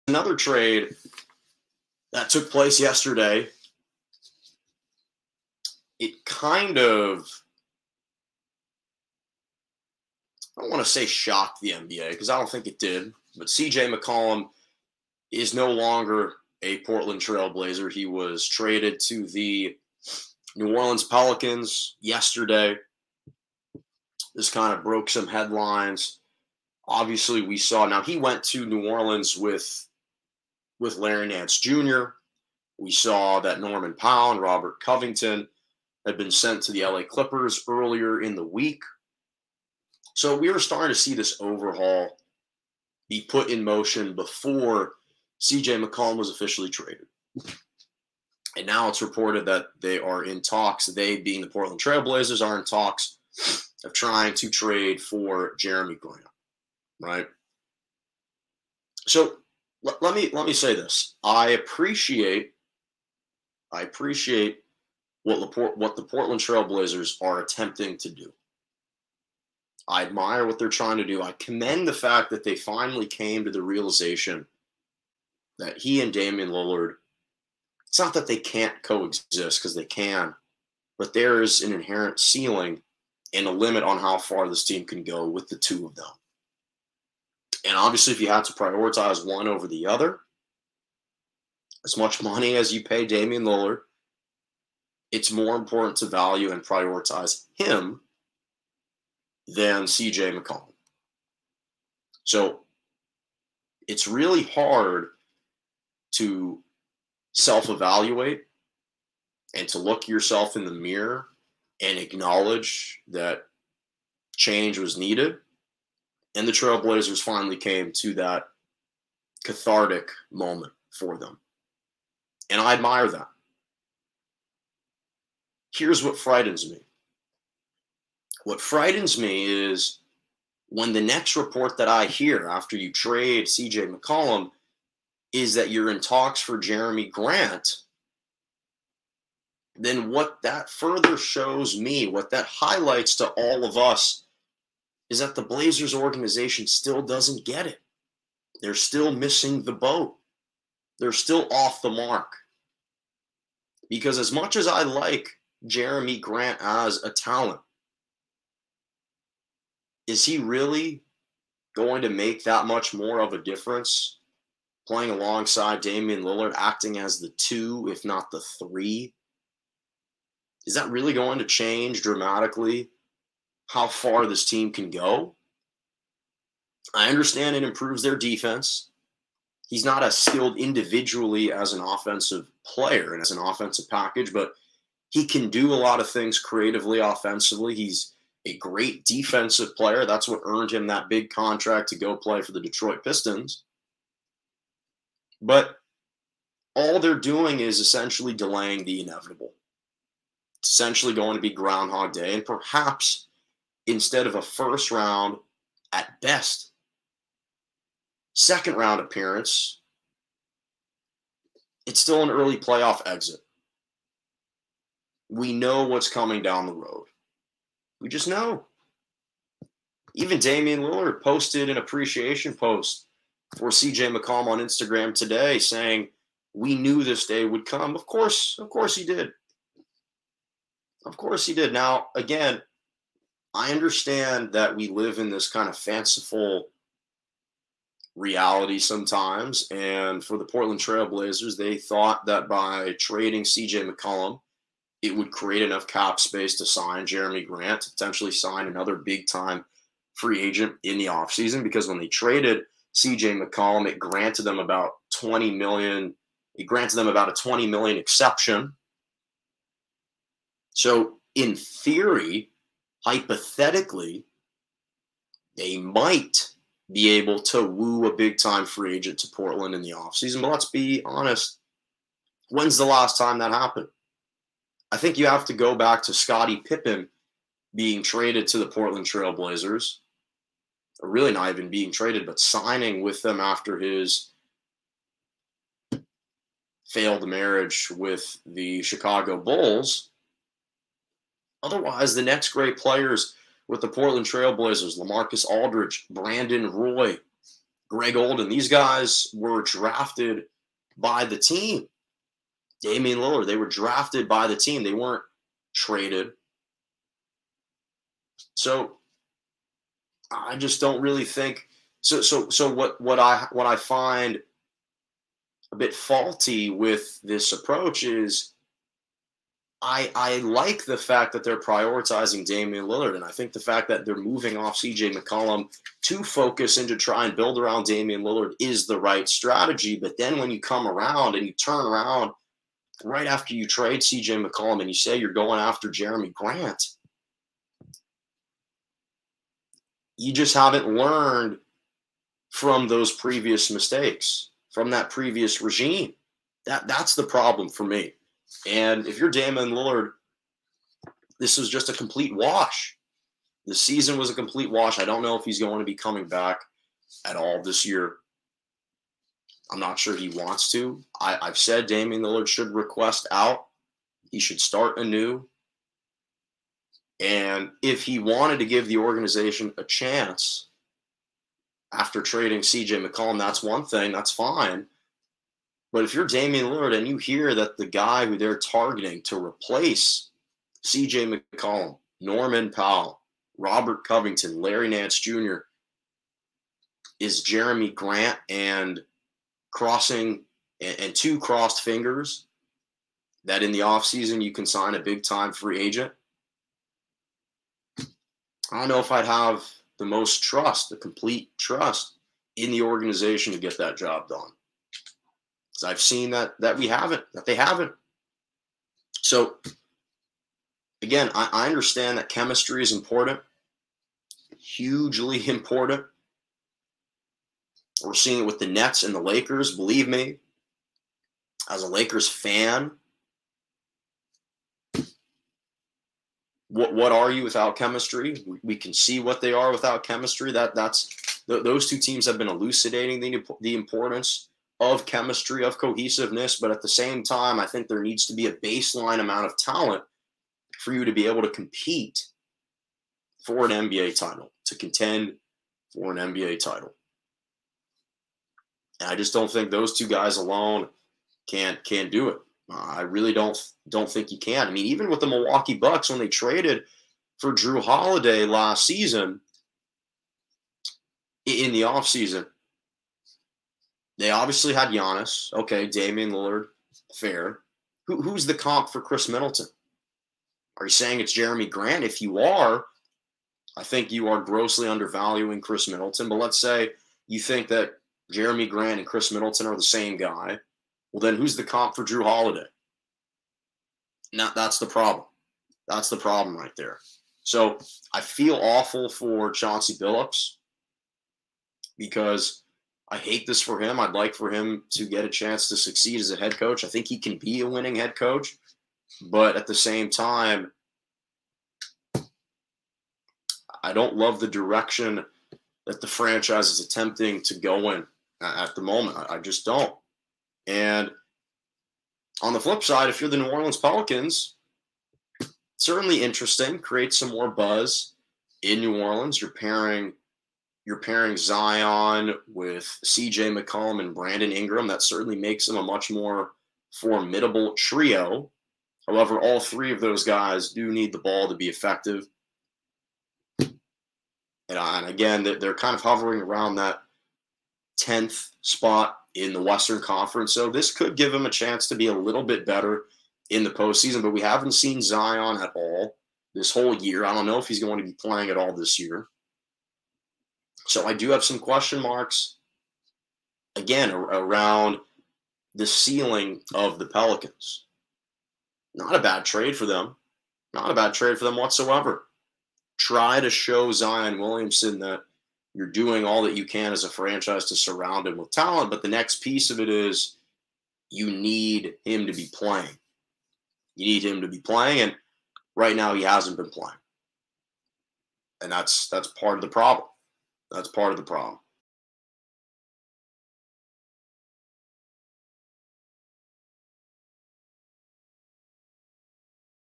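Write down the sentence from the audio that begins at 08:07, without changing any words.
So I feel awful for Chauncey Billups because I hate this for him.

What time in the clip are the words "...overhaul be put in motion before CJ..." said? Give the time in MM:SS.
00:41.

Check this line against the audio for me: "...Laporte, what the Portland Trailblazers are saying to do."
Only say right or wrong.
wrong.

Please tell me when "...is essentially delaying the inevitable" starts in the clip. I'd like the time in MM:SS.
03:17.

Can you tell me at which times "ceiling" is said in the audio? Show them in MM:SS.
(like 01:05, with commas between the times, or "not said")
01:22, 09:15.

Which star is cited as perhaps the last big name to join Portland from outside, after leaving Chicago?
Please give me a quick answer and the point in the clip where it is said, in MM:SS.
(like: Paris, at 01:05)
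Scottie Pippen, at 04:36.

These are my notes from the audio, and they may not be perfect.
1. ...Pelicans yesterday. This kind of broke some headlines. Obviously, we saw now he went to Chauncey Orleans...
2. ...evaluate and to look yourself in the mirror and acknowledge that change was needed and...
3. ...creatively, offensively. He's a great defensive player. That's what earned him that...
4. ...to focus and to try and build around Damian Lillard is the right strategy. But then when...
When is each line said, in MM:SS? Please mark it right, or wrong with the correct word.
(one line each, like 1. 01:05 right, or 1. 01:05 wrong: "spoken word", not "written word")
1. 00:21 wrong: "New", not "Chauncey"
2. 01:47 right
3. 03:06 right
4. 05:26 right.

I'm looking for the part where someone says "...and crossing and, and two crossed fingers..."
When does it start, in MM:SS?
06:28.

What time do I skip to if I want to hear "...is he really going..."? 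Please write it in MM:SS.
02:40.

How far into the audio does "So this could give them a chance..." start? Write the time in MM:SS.
09:00.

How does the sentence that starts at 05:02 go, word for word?
Damian Lillard, they were drafted by the team.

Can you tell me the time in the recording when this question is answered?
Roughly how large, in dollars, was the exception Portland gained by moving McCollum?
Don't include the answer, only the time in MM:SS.
04:17.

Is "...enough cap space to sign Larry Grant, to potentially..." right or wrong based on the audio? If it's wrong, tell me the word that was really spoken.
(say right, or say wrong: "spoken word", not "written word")
wrong: "Jerami", not "Larry".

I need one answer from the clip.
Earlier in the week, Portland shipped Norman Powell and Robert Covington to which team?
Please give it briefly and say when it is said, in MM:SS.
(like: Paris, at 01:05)
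LA Clippers, at 00:36.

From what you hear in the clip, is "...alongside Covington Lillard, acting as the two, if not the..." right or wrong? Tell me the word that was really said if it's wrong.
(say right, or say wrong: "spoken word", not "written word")
wrong: "Damian", not "Covington".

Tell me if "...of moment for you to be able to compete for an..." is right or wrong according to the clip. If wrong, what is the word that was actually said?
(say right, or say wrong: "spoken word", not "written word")
wrong: "talent", not "moment".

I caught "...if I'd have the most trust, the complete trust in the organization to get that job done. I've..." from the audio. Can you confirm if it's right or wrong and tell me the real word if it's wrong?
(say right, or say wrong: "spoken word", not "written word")
right.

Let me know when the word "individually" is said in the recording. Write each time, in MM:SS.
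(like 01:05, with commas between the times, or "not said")
03:00.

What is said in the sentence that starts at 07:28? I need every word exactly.
And I just don't think those two guys alone can can do it.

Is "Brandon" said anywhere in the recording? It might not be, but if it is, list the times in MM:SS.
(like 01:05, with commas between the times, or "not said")
04:56, 08:44.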